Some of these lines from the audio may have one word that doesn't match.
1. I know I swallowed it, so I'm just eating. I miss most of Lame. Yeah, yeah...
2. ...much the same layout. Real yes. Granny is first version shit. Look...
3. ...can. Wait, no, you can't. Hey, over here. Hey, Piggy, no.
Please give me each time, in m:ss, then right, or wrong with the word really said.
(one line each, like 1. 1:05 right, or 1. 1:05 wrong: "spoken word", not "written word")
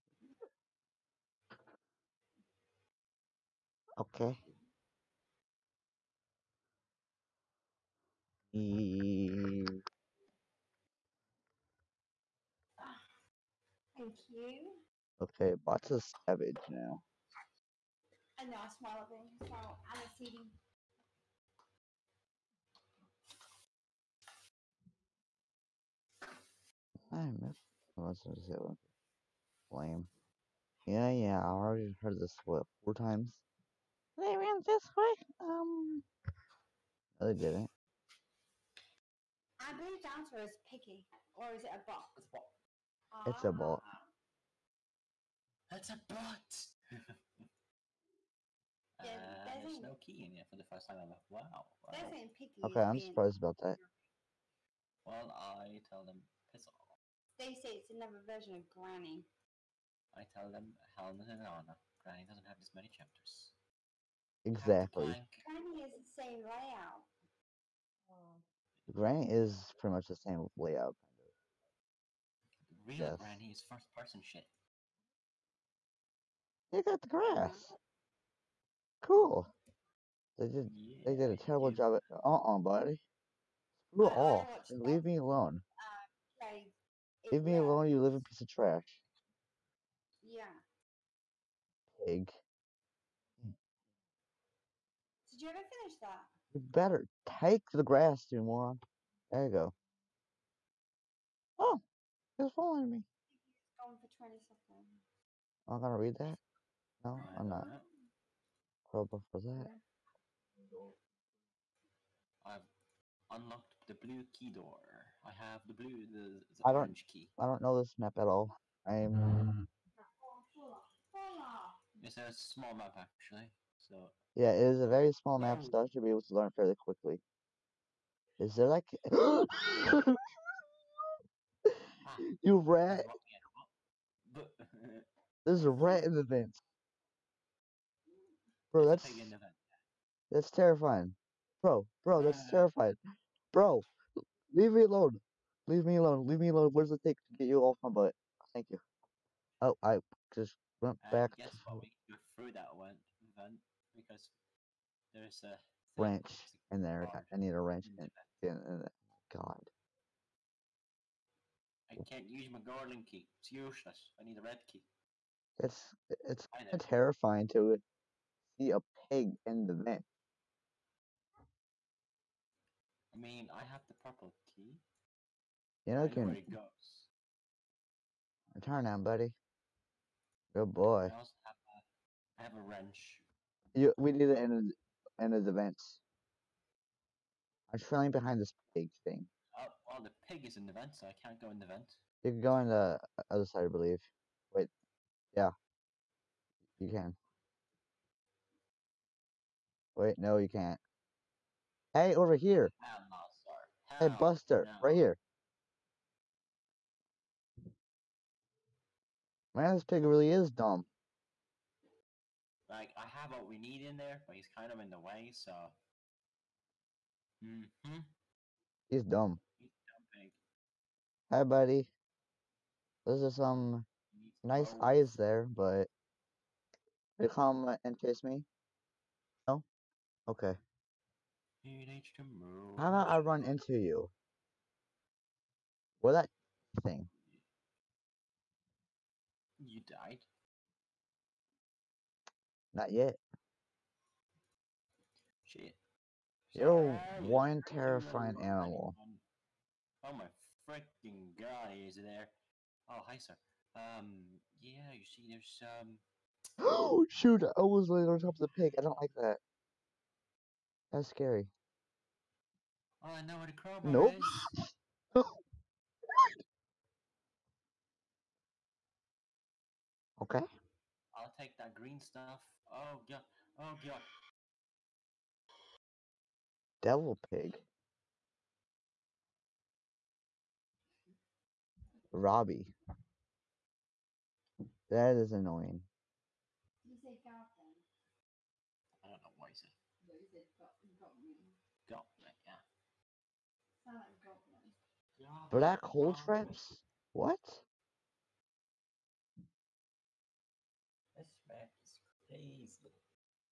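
1. 0:18 right
2. 1:09 wrong: "person", not "version"
3. 3:16 wrong: "Buster", not "Piggy".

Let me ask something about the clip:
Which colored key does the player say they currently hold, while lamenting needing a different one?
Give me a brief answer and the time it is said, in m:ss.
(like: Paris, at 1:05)
purple key, at 2:53.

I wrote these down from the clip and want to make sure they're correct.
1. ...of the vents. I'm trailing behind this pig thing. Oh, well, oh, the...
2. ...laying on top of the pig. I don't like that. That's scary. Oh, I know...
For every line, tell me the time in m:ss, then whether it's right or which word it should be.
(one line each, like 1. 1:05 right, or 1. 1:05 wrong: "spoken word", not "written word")
1. 3:05 right
2. 4:17 right.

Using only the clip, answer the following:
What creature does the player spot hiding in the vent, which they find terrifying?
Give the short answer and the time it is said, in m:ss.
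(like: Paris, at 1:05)
a rat, at 2:15.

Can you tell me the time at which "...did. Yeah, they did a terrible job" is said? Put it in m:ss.
1:20.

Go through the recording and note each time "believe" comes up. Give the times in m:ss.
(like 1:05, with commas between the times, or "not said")
0:39, 3:13.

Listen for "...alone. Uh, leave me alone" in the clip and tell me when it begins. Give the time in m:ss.
1:25.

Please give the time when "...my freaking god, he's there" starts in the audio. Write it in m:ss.
4:10.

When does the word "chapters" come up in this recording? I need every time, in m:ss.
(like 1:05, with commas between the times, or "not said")
1:02.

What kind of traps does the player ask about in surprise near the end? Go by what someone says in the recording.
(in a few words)
Black hole traps.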